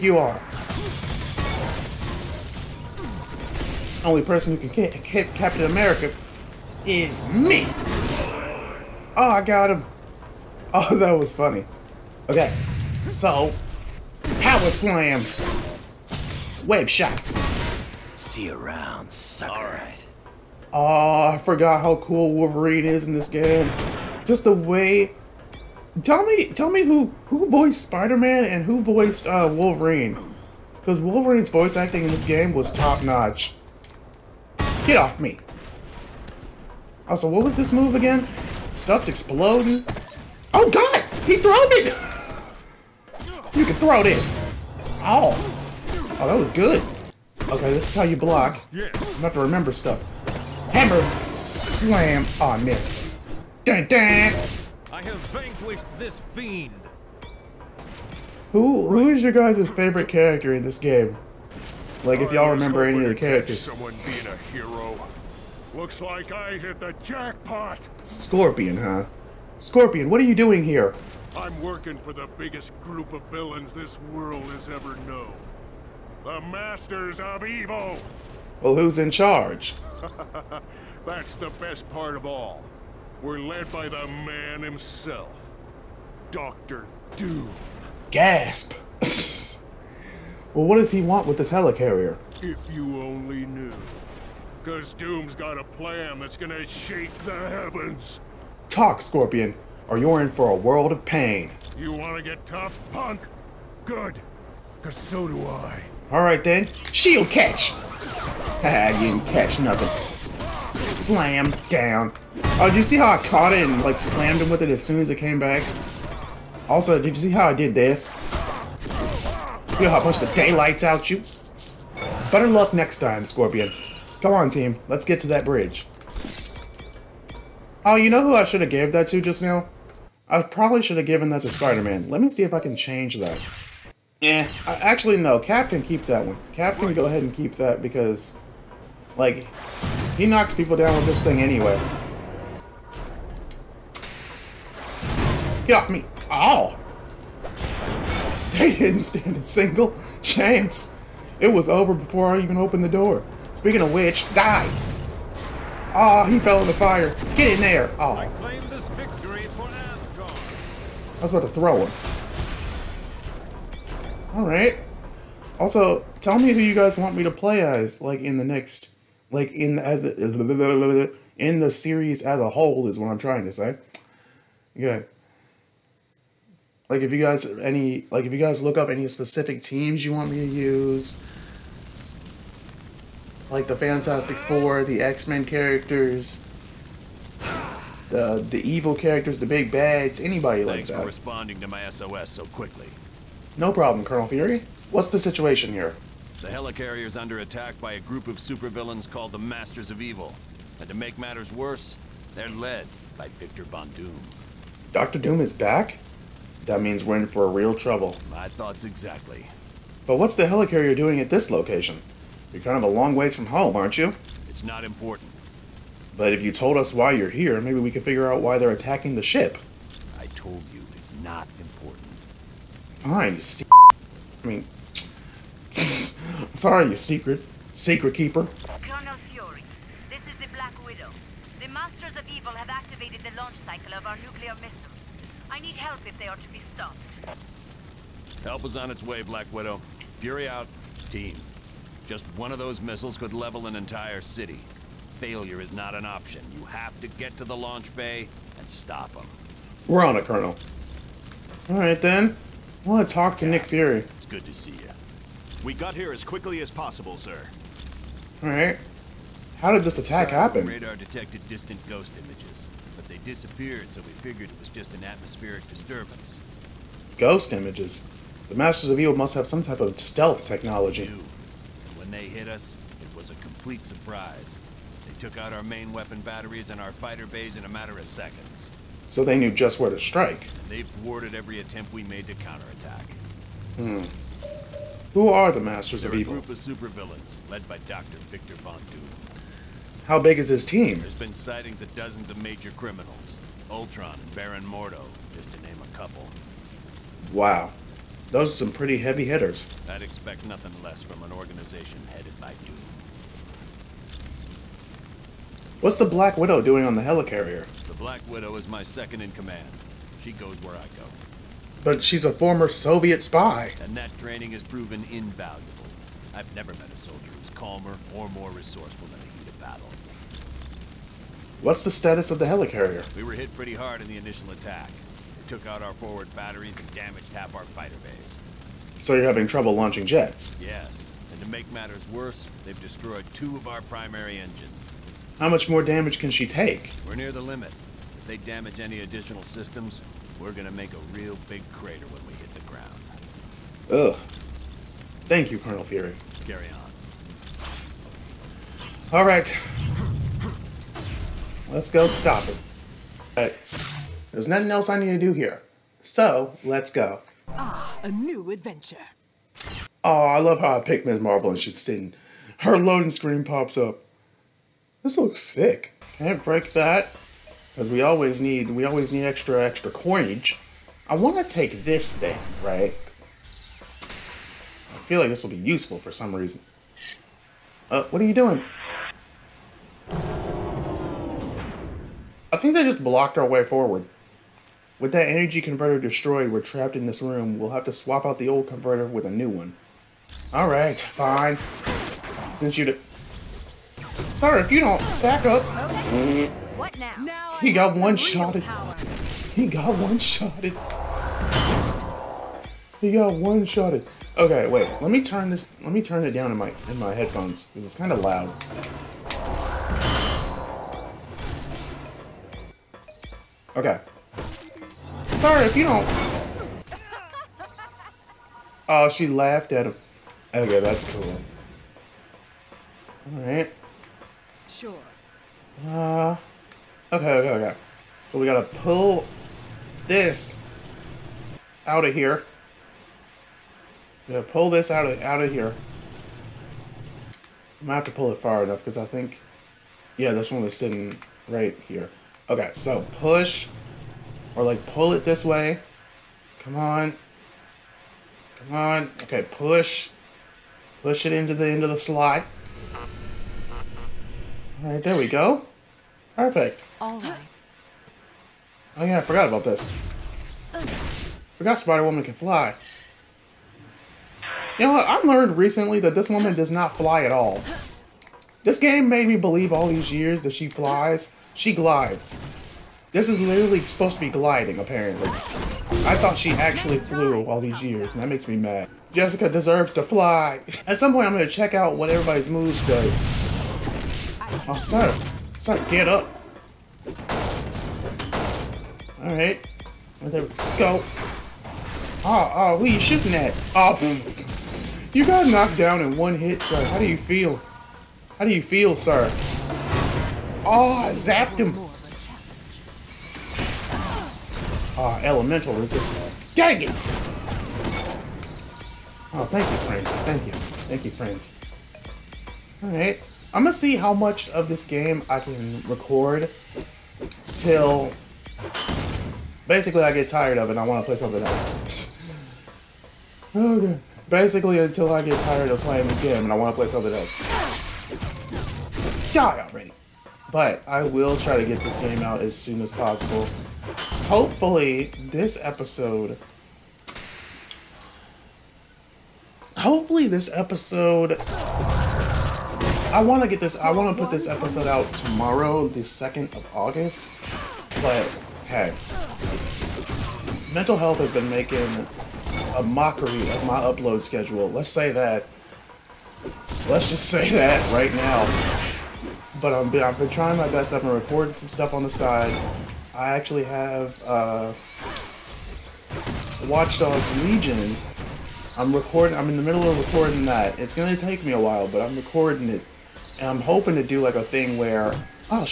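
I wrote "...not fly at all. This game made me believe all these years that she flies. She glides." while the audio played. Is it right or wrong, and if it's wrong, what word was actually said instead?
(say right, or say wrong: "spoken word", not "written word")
right.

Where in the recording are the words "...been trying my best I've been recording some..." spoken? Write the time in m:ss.
9:20.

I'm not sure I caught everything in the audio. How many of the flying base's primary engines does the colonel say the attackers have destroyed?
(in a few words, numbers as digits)
2.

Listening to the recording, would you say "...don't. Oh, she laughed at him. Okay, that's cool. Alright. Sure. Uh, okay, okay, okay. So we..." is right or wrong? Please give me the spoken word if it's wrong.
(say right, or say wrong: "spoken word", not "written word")
right.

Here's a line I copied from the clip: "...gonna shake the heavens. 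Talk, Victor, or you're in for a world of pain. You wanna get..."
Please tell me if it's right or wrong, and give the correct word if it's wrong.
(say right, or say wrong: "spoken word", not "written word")
wrong: "Scorpion", not "Victor".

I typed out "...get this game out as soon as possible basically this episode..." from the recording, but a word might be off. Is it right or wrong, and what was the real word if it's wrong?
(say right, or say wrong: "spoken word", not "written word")
wrong: "hopefully", not "basically".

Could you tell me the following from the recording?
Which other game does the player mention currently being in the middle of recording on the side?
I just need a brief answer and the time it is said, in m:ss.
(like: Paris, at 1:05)
Watch Dogs Legion, at 9:26.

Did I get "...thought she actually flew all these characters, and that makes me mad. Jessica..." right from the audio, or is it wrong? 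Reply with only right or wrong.
wrong.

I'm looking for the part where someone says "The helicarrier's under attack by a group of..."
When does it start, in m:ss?
3:16.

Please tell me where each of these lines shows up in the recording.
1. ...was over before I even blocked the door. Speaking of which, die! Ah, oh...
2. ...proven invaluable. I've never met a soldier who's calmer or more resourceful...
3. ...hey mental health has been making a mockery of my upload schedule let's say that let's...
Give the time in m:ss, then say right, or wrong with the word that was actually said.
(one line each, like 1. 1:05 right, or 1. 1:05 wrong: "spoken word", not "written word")
1. 2:31 wrong: "opened", not "blocked"
2. 5:14 right
3. 9:08 right.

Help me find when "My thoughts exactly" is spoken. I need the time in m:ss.
3:28.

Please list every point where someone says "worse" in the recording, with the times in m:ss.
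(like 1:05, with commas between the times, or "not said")
3:21, 5:32.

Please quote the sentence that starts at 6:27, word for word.
We'll have to swap out the old converter with a new one.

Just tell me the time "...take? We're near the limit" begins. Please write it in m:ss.
5:36.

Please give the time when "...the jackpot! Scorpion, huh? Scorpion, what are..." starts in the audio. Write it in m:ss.
1:06.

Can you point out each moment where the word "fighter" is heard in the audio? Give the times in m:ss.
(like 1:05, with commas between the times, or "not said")
4:36, 5:27.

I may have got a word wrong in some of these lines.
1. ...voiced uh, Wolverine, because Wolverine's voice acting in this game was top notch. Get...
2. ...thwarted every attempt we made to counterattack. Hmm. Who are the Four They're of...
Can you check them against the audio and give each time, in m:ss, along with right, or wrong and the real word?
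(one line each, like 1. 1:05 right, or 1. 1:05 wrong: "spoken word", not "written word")
1. 0:28 right
2. 4:40 wrong: "Masters", not "Four".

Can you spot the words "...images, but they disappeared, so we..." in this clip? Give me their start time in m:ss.
4:22.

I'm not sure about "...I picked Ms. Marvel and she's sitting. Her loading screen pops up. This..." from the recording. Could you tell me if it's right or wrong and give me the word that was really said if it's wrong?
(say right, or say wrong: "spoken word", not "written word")
right.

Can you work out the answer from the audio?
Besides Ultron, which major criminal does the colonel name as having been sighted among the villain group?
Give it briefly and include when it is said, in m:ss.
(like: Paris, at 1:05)
Baron Mordo, at 4:54.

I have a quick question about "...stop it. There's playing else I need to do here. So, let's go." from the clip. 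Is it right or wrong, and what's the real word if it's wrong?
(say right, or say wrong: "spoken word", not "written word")
wrong: "nothing", not "playing".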